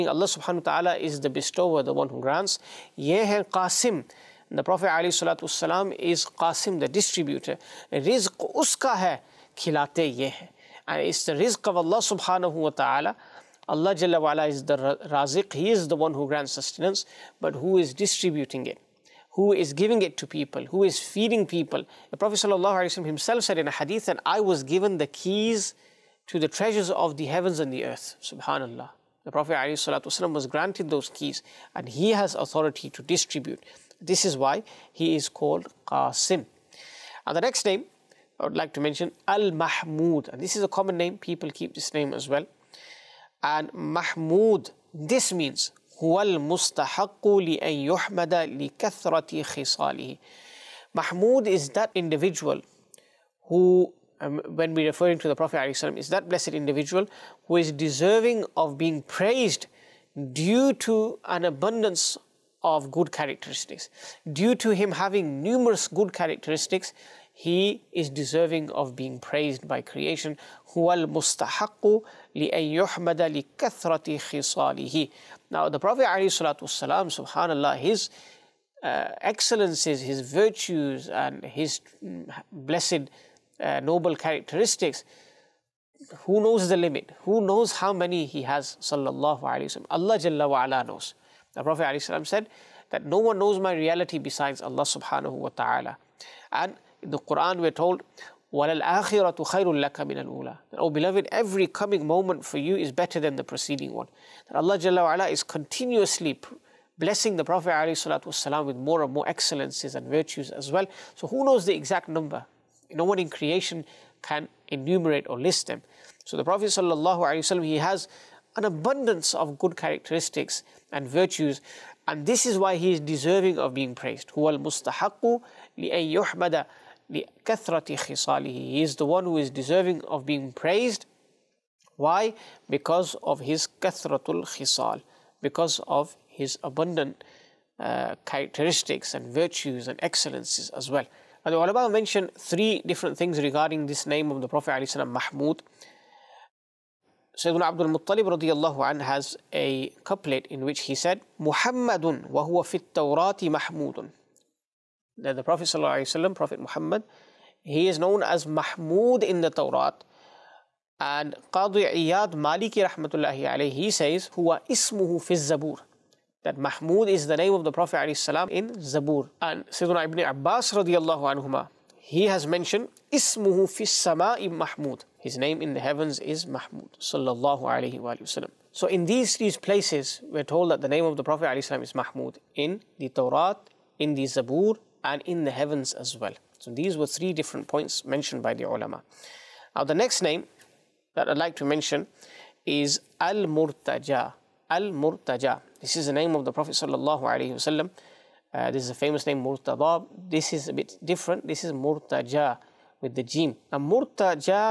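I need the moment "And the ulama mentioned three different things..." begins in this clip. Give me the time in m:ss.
2:21.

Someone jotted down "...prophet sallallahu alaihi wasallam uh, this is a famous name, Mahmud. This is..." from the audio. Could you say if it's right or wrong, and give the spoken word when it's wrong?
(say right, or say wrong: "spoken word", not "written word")
wrong: "Murtada", not "Mahmud".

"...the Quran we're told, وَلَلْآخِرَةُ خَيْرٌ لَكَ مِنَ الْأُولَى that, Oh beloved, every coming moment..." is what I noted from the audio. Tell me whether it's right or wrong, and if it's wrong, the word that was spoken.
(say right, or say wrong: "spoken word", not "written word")
right.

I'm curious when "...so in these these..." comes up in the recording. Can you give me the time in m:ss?
2:58.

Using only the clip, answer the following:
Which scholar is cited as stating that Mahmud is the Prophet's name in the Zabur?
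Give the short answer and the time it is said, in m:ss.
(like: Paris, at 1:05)
Qadi Iyad Maliki, at 2:41.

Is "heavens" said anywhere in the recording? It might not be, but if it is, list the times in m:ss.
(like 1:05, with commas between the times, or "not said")
0:27, 2:55, 3:05.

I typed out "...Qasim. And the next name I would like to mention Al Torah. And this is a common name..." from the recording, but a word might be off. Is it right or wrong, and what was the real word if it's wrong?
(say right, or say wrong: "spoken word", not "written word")
wrong: "Mahmud", not "Torah".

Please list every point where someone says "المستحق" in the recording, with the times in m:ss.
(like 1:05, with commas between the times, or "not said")
0:46, 1:10, 2:04.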